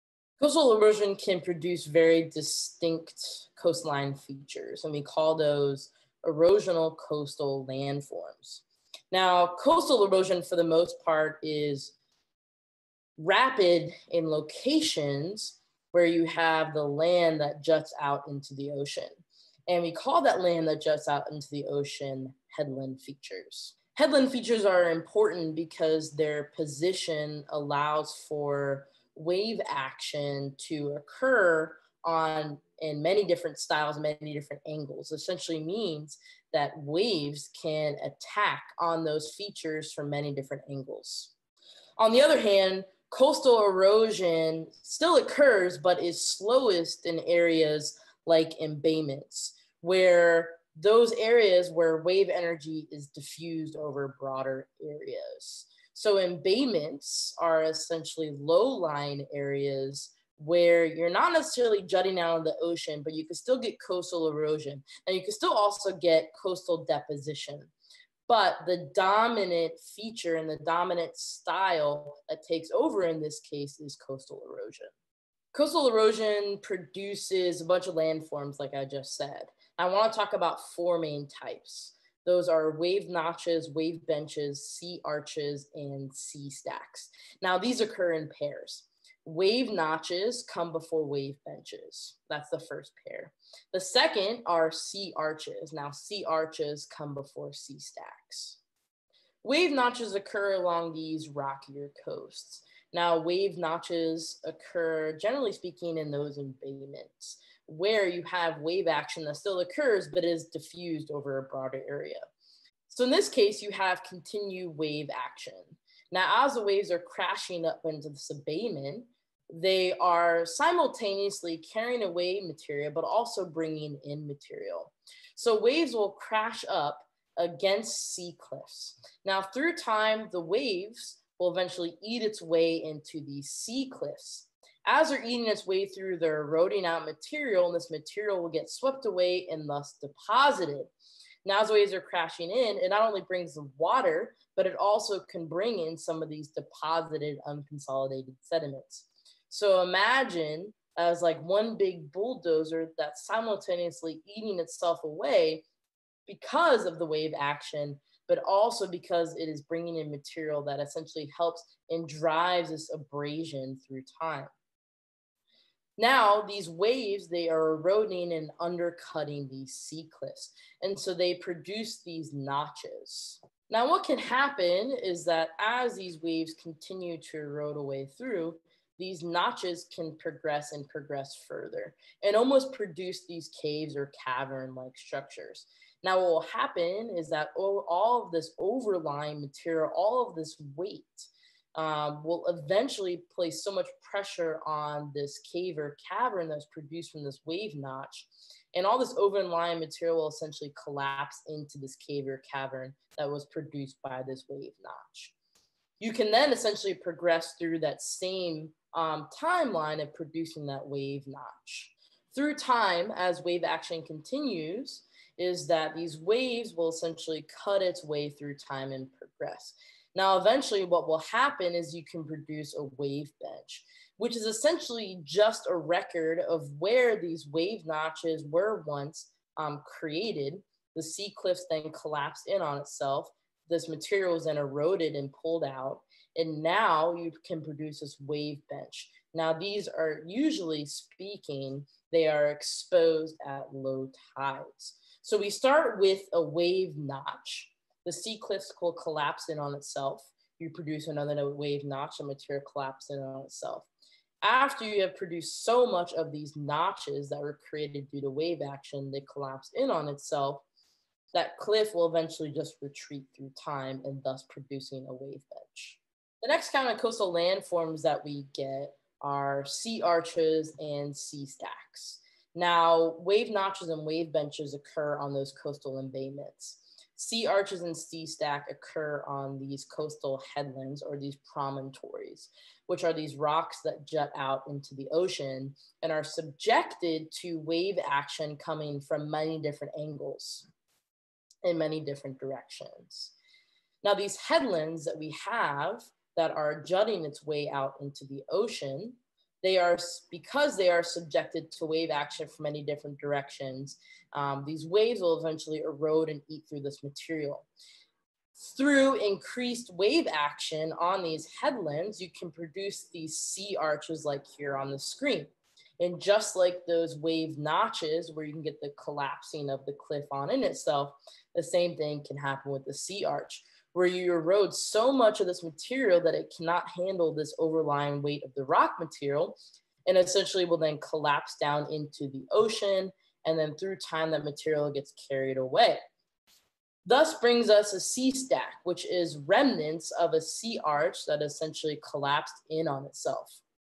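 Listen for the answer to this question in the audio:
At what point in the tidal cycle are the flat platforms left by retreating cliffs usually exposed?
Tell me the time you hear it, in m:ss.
4:03.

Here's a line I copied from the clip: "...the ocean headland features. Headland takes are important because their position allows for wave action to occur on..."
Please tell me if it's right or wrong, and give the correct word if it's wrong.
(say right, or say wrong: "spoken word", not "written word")
wrong: "features", not "takes".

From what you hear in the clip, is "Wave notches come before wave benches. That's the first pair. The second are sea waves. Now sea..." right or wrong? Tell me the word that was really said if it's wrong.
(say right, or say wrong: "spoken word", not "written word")
wrong: "arches", not "waves".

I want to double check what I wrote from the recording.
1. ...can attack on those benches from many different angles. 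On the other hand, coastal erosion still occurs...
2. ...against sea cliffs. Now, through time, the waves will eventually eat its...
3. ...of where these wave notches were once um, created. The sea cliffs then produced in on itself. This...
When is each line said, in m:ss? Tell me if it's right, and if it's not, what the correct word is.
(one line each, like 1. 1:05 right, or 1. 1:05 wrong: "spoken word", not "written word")
1. 0:37 wrong: "features", not "benches"
2. 2:07 right
3. 3:46 wrong: "collapsed", not "produced".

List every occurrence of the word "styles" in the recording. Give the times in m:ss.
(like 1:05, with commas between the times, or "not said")
0:33, 1:11.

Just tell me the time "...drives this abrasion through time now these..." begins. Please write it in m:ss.
2:42.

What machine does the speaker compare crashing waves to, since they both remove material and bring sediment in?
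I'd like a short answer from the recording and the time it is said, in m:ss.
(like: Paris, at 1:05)
Bulldozer, at 2:31.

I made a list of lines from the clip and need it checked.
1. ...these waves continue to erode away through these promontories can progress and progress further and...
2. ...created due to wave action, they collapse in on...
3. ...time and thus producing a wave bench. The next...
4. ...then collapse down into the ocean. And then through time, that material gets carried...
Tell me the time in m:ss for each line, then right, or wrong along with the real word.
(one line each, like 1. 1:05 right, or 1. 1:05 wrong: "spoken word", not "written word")
1. 2:55 wrong: "notches", not "promontories"
2. 4:17 right
3. 4:23 right
4. 5:30 right.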